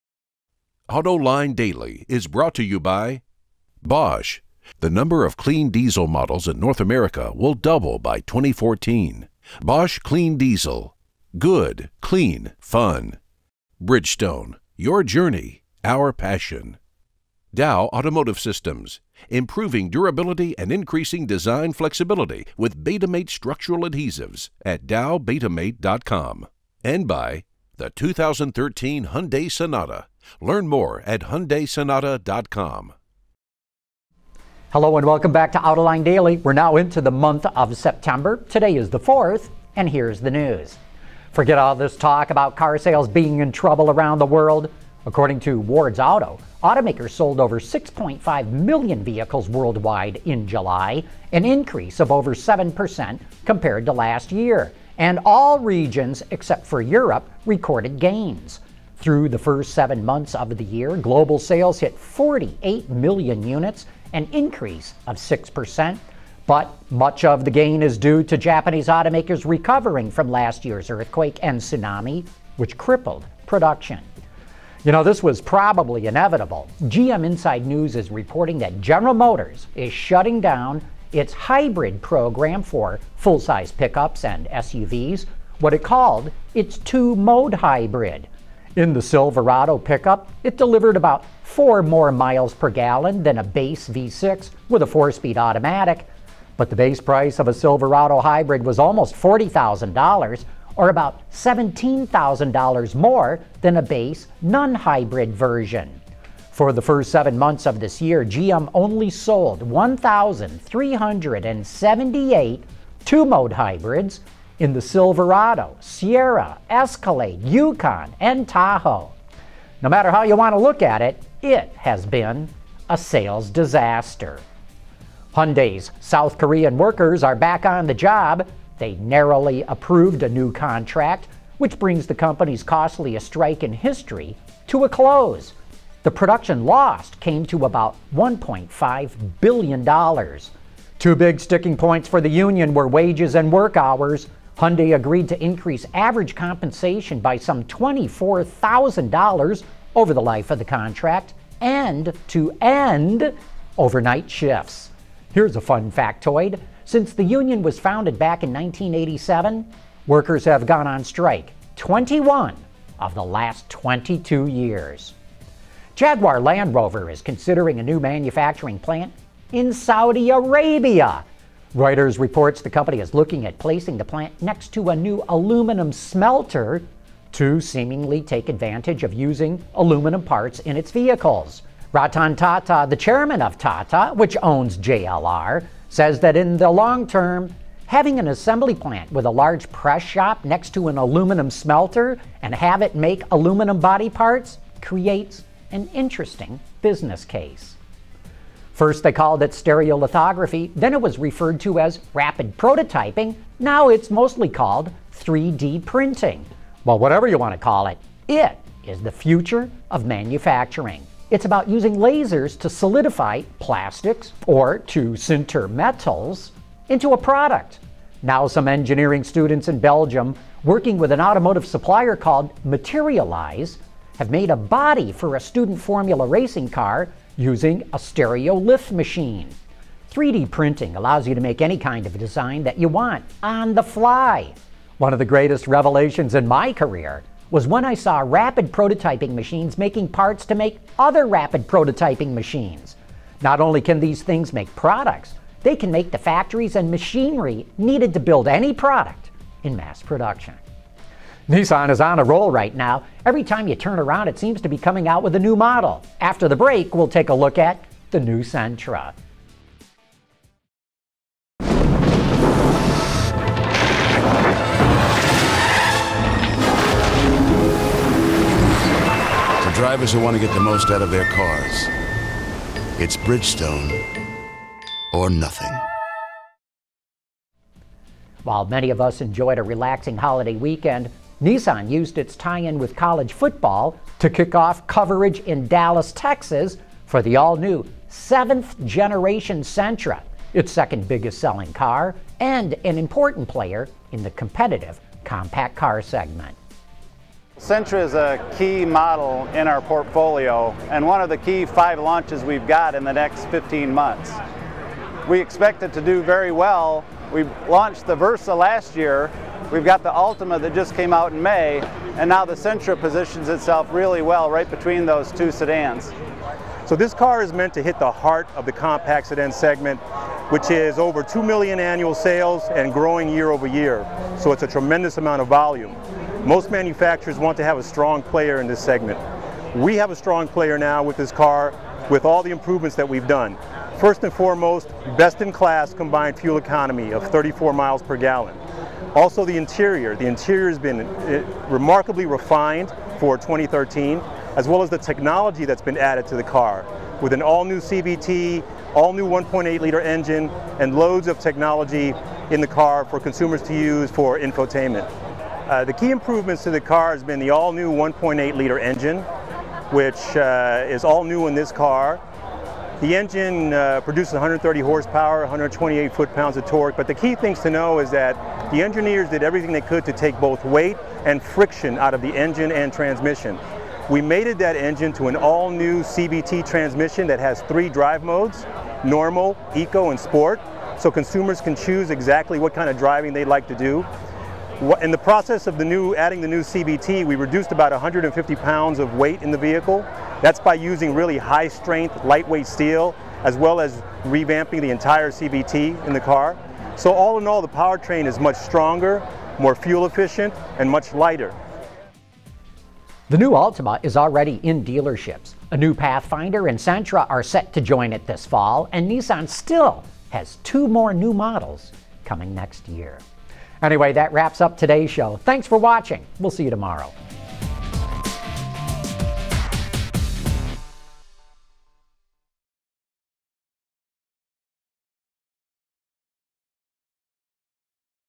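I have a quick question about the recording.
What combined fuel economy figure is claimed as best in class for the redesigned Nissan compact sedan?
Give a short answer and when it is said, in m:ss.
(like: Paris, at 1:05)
34 miles per gallon, at 5:37.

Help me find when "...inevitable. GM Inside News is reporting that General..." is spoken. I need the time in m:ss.
1:16.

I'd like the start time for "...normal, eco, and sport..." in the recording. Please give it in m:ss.
6:19.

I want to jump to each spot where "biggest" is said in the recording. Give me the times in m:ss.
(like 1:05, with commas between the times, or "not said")
4:51.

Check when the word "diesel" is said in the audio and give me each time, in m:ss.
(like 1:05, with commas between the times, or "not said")
0:05, 0:10.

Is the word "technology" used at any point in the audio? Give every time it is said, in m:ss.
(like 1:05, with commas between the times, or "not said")
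5:44, 5:51.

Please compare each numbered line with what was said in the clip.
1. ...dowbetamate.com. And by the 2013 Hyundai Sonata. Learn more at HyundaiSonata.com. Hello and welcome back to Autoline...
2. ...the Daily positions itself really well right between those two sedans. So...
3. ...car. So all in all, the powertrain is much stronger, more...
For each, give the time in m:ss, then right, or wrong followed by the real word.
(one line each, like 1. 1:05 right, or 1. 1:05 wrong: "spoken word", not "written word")
1. 0:24 right
2. 5:12 wrong: "Sentra", not "Daily"
3. 6:36 right.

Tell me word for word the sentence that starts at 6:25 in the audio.
In the process of the new, adding the new CVT, we reduced about 150 pounds of weight in the vehicle.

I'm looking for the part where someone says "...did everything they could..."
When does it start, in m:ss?
6:09.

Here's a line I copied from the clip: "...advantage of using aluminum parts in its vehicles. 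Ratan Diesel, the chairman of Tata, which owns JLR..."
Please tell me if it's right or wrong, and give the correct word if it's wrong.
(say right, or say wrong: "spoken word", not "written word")
wrong: "Tata", not "Diesel".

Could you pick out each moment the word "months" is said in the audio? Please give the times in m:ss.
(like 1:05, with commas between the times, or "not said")
0:37, 1:00, 1:47, 5:03.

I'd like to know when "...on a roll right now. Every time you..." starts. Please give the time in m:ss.
4:11.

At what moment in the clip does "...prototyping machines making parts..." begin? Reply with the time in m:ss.
3:58.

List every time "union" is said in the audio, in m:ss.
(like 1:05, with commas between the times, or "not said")
2:22, 2:37.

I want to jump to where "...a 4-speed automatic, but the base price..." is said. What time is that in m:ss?
1:34.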